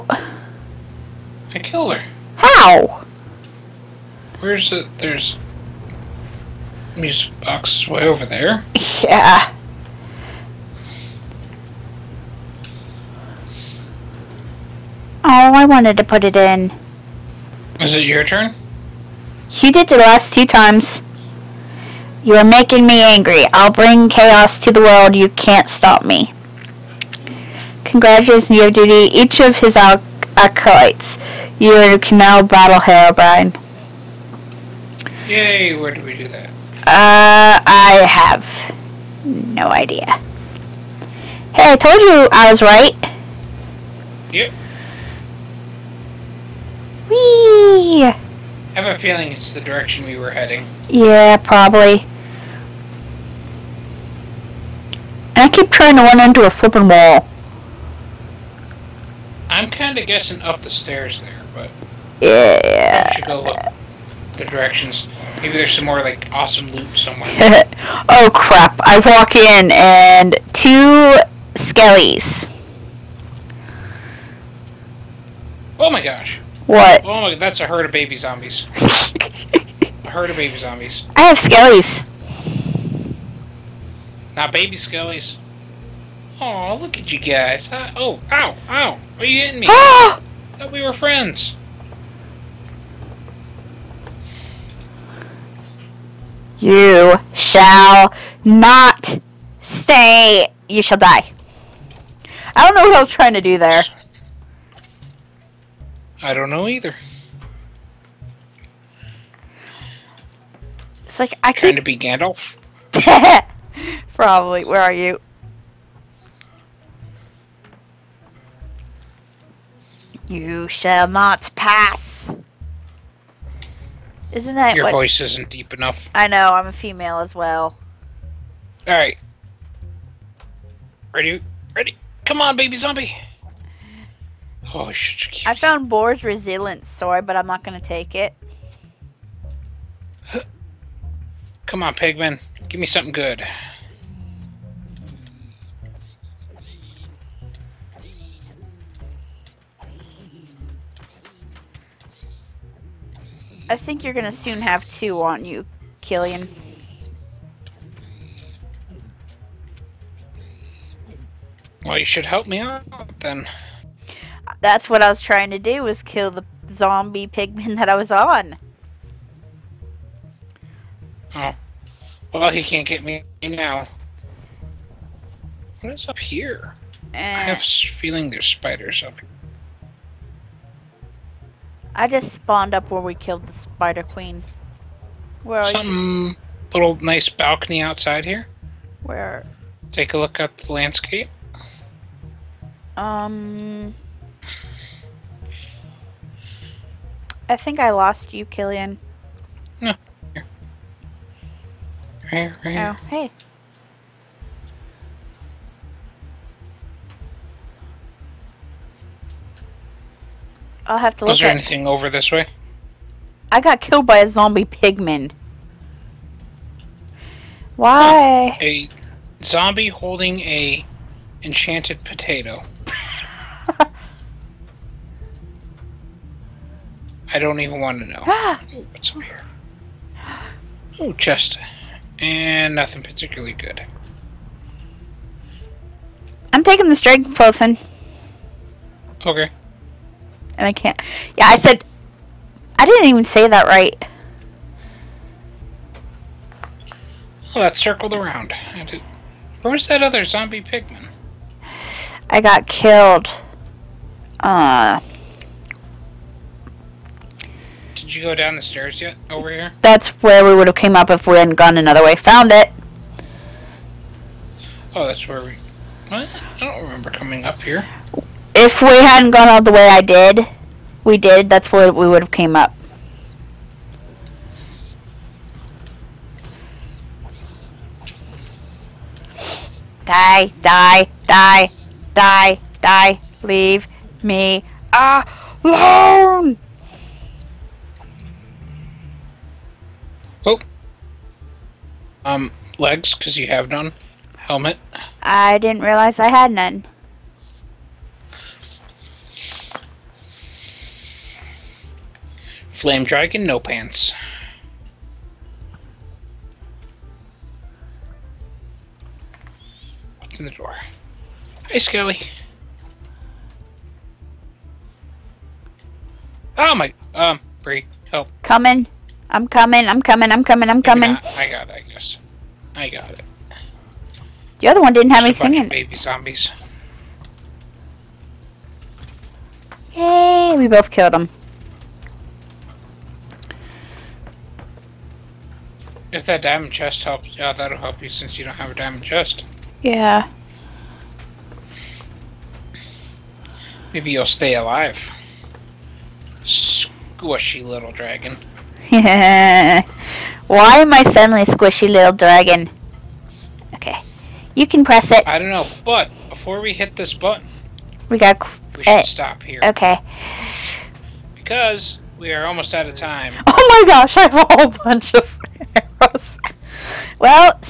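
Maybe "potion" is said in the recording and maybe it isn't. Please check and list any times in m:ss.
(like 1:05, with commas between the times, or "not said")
3:57.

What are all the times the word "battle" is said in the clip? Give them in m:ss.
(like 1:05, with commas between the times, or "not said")
0:32.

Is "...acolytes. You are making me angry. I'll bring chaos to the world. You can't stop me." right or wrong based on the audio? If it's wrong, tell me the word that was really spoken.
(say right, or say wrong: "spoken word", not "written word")
wrong: "times", not "acolytes".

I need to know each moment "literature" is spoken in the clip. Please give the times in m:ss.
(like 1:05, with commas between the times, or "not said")
not said.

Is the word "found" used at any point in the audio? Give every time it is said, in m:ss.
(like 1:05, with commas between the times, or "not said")
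2:15, 4:22.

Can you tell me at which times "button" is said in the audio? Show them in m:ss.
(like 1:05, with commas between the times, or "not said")
5:57.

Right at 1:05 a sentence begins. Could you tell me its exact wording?
Maybe there's some more, like, awesome loot somewhere.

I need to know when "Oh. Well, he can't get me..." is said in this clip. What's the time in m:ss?
2:51.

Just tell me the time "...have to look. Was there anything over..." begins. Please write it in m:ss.
3:30.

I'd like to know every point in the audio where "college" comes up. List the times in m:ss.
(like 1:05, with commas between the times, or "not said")
not said.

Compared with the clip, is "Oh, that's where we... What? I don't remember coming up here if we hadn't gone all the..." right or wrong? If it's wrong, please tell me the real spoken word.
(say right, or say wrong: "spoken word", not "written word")
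right.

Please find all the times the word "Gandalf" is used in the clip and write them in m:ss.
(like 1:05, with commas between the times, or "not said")
1:51.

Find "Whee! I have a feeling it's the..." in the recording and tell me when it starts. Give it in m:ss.
0:47.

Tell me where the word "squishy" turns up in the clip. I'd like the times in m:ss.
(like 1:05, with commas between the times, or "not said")
5:46, 5:51.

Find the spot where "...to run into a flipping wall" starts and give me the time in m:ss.
0:55.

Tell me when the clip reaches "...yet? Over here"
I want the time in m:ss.
4:19.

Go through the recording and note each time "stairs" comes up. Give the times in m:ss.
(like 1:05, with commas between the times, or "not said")
1:00, 4:18.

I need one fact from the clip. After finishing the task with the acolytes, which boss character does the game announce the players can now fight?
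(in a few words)
Herobrine.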